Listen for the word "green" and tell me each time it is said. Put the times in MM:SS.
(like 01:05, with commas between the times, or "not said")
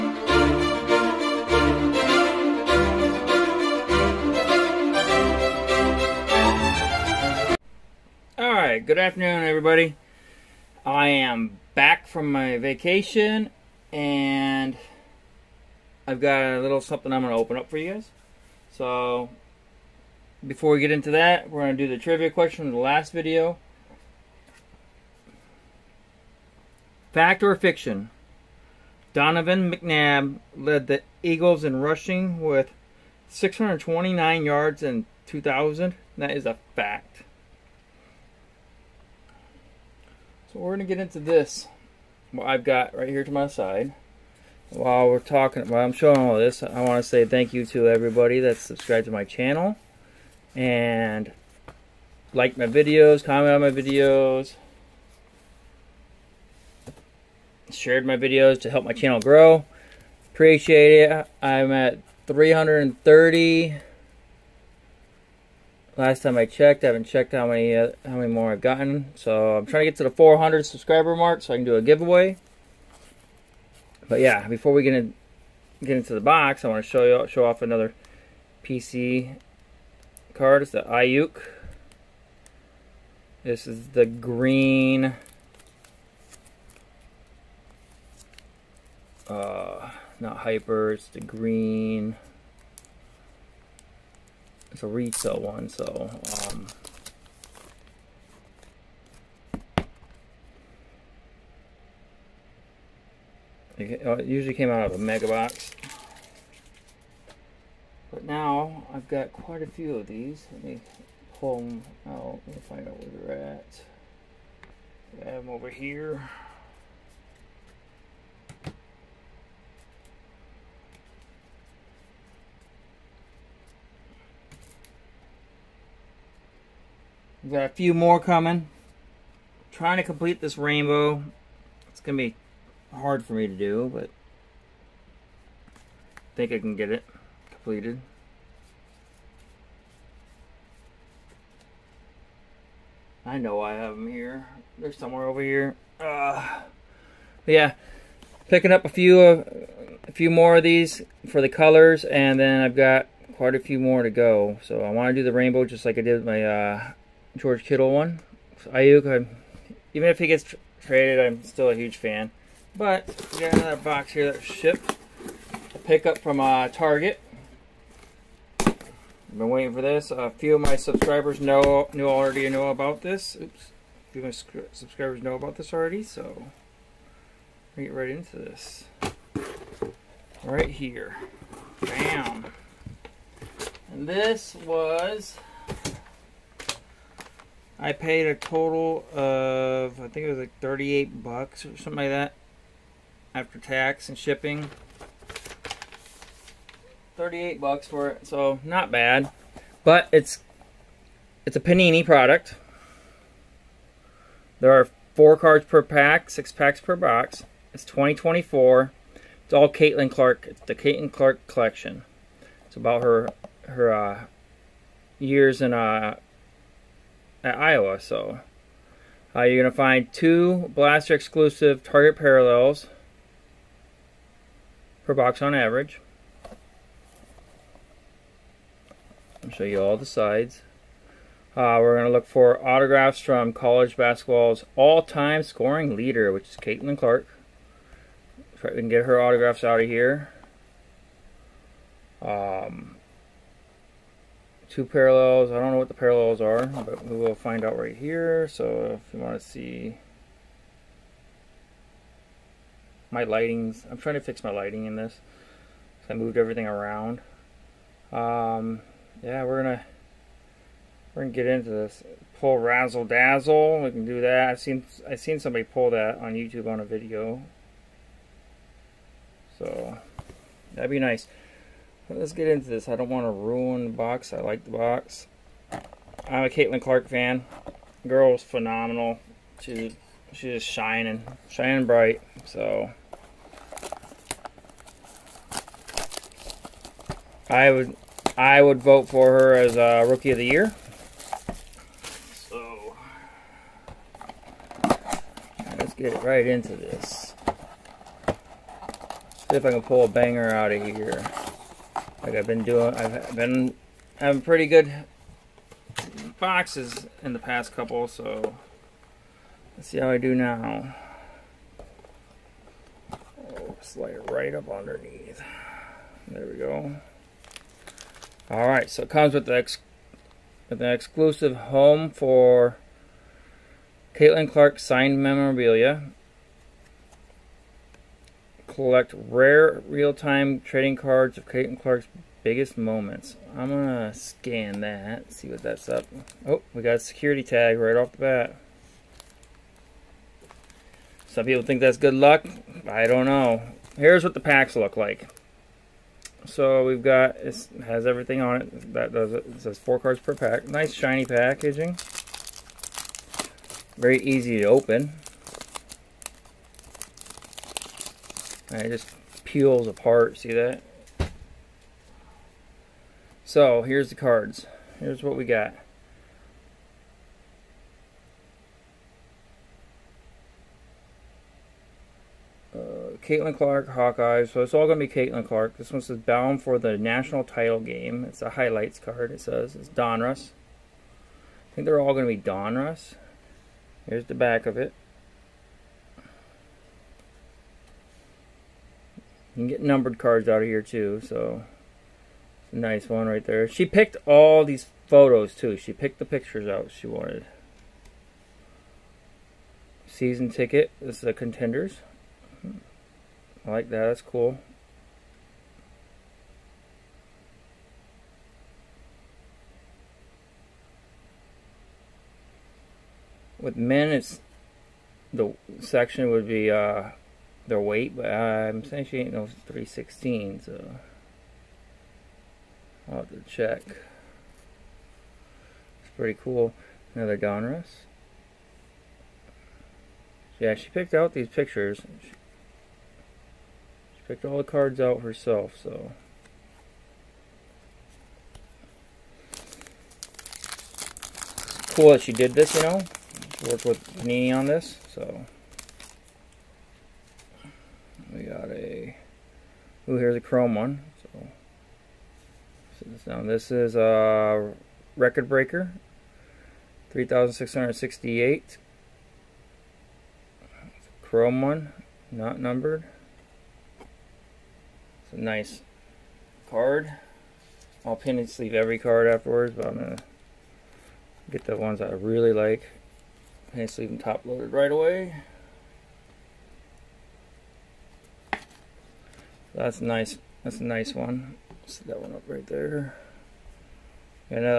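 01:24, 01:31.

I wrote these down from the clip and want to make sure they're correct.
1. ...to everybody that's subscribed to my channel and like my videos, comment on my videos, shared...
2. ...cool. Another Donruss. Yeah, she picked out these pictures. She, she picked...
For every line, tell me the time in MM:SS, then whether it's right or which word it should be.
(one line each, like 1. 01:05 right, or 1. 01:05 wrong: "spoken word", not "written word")
1. 00:47 right
2. 07:06 right.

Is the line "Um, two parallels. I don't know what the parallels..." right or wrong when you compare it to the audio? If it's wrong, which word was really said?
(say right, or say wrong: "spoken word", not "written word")
right.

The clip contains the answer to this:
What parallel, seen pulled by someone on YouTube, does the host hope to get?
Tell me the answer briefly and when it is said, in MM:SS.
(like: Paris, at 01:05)
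Razzle dazzle, at 04:22.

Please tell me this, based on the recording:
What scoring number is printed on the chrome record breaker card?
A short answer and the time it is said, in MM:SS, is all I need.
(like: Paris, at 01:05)
3,668, at 07:37.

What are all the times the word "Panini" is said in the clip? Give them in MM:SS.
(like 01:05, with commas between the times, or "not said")
03:21, 07:24.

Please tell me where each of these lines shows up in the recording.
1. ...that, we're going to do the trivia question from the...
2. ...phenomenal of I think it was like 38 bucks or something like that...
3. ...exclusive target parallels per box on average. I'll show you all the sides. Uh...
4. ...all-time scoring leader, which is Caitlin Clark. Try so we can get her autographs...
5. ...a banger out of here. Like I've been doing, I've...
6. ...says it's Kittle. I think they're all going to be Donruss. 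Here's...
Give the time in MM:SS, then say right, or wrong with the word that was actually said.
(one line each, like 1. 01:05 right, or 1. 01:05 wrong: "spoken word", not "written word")
1. 00:21 right
2. 03:08 wrong: "total", not "phenomenal"
3. 03:41 right
4. 03:54 right
5. 05:00 right
6. 06:19 wrong: "Donruss", not "Kittle".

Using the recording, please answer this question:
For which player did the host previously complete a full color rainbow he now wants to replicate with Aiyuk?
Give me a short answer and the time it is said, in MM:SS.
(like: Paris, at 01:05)
George Kittle, at 02:37.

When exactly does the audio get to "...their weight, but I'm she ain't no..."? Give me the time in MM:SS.
06:57.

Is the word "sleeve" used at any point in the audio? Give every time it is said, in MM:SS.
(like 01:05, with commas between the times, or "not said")
07:48, 07:53.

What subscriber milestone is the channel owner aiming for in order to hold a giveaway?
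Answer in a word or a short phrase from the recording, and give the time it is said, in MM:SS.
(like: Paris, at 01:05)
400, at 01:10.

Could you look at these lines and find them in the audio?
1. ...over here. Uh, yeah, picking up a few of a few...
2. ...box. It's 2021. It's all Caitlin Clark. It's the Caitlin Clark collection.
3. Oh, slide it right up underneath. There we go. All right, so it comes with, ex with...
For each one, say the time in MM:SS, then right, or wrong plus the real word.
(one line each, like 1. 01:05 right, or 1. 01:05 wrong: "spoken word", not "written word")
1. 02:25 right
2. 03:26 wrong: "2024", not "2021"
3. 05:13 right.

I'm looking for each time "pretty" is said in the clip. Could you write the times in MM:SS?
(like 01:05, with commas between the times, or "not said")
05:04, 07:06.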